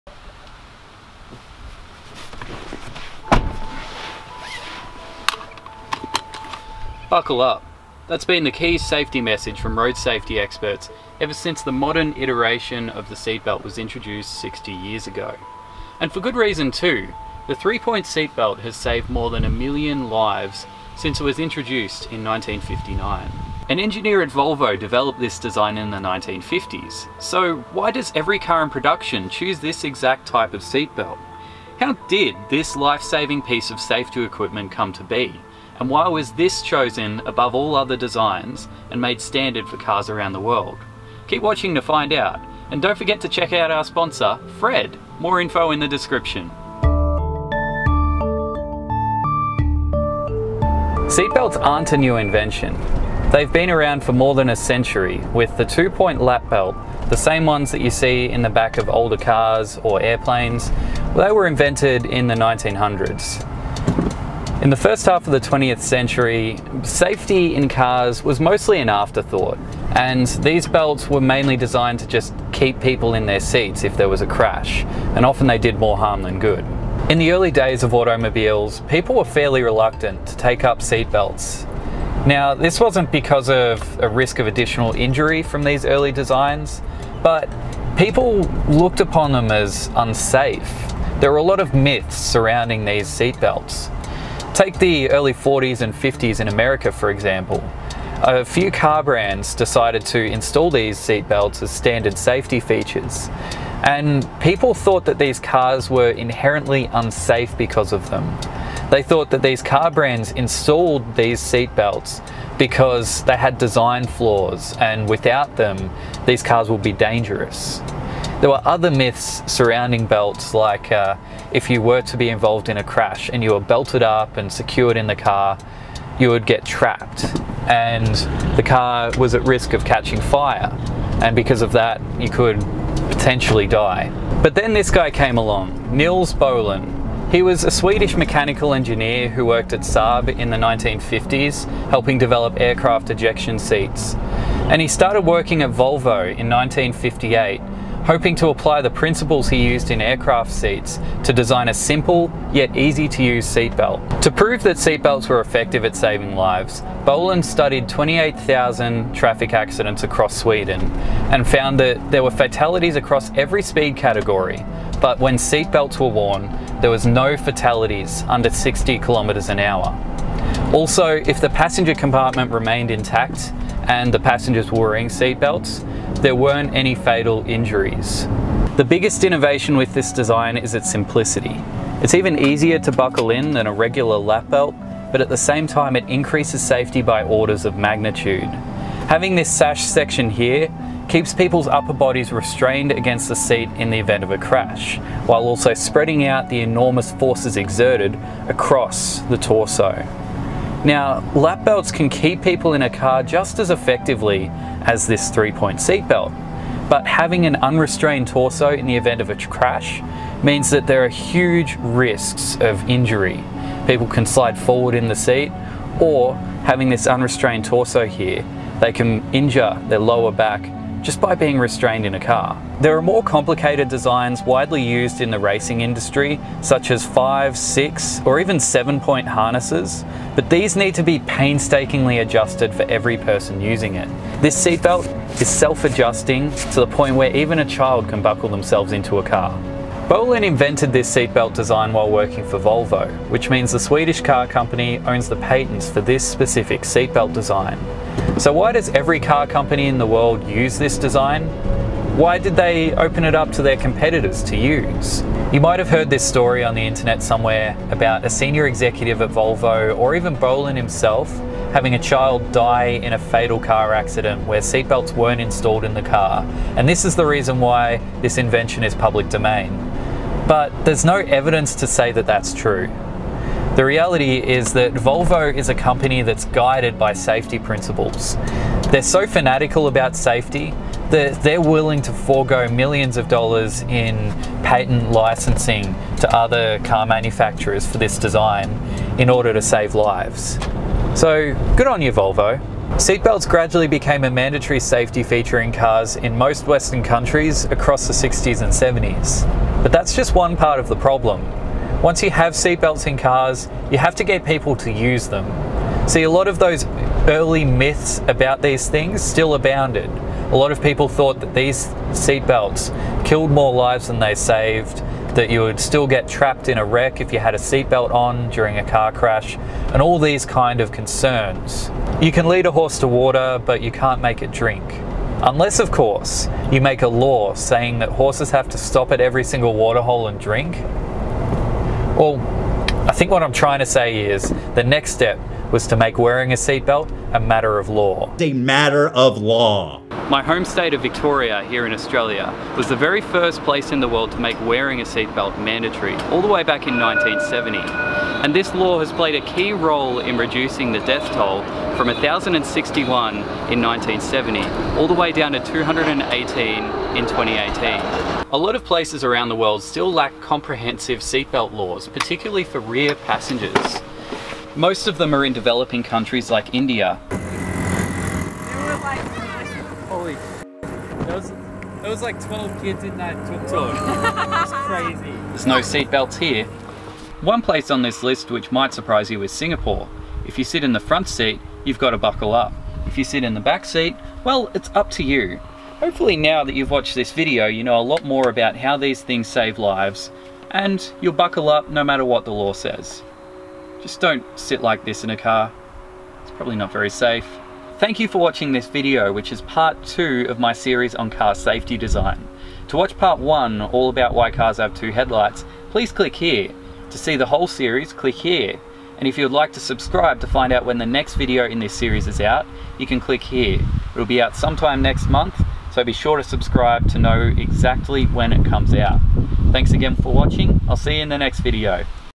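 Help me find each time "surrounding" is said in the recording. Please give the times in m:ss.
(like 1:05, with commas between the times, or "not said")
1:32, 1:59.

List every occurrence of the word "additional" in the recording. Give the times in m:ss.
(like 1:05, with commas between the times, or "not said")
1:24.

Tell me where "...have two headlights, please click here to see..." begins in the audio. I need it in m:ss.
6:44.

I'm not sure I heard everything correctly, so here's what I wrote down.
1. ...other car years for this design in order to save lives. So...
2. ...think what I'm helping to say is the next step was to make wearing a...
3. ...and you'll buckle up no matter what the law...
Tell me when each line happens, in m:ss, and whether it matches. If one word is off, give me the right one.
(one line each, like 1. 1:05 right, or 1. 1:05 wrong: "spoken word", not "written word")
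1. 4:46 wrong: "manufacturers", not "years"
2. 5:33 wrong: "trying", not "helping"
3. 6:30 right.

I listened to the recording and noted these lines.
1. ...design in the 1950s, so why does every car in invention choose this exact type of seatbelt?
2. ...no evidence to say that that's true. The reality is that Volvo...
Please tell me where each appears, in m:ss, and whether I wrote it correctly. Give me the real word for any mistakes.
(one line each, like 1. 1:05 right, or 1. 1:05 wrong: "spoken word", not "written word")
1. 0:25 wrong: "production", not "invention"
2. 4:31 right.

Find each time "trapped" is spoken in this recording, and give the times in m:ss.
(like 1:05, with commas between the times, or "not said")
2:06, 5:16.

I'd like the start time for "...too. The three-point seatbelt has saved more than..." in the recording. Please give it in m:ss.
0:16.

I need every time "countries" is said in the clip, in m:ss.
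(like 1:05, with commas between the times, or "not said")
4:57, 6:06.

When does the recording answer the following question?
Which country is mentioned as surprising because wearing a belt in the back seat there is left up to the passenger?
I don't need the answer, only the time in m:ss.
6:19.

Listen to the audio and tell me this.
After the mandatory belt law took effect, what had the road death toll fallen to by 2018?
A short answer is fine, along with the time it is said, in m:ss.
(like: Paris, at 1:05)
218, at 5:55.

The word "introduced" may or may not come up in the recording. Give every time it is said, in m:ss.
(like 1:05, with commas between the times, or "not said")
0:13, 0:21.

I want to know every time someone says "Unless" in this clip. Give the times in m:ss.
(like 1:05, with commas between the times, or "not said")
5:25.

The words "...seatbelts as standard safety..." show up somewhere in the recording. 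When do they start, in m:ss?
1:40.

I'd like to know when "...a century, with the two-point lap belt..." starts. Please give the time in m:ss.
0:54.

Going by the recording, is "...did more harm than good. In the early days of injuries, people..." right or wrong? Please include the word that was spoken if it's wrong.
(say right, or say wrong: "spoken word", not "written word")
wrong: "automobiles", not "injuries".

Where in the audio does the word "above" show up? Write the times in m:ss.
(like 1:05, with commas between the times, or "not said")
0:37.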